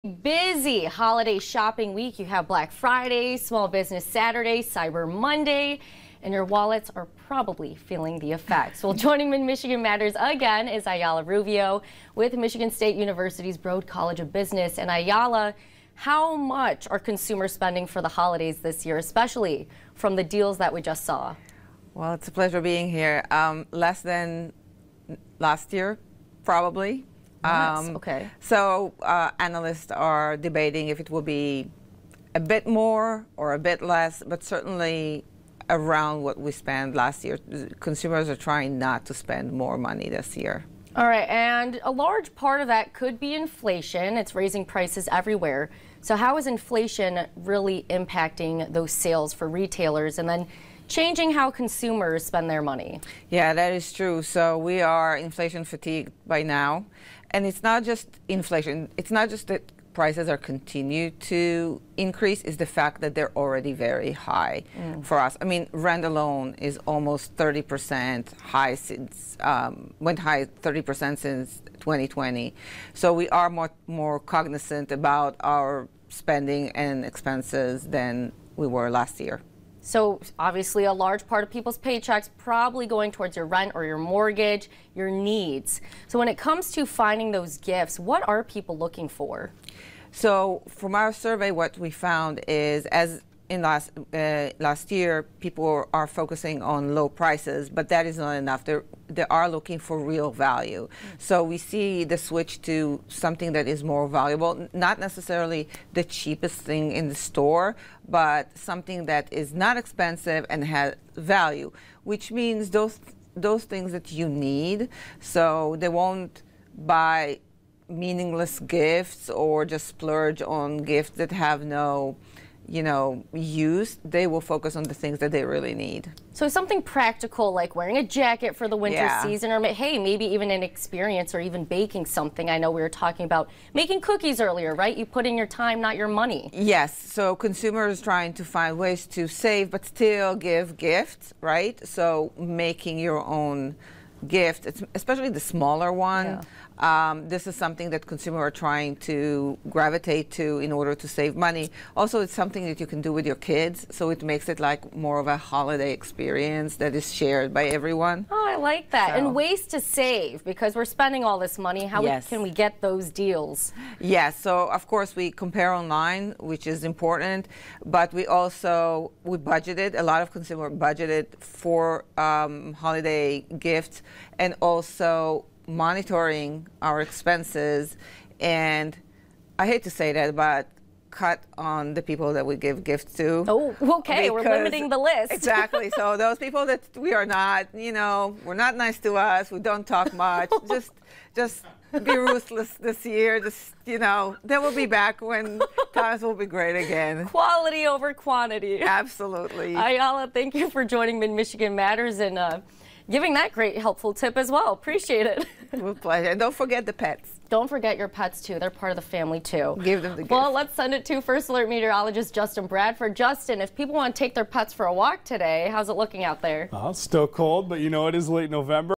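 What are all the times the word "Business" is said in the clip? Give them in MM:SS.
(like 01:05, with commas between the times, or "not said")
00:03, 00:14.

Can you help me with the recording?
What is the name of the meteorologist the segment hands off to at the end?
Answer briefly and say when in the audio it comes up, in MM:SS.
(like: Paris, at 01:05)
Justin Bradford, at 03:32.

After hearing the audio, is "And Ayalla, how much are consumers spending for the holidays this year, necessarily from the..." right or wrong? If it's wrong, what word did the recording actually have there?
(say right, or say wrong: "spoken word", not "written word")
wrong: "especially", not "necessarily".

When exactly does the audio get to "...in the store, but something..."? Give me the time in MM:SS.
01:46.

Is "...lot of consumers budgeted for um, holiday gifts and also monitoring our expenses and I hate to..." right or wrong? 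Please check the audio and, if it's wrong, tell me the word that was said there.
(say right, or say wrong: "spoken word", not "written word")
right.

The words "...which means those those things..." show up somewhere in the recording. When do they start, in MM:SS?
01:52.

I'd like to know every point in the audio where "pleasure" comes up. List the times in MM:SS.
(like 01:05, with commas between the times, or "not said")
00:22, 03:26.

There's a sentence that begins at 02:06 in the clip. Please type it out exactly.
So something practical like wearing a jacket for the winter yeah.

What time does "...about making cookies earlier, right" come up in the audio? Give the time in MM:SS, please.
02:13.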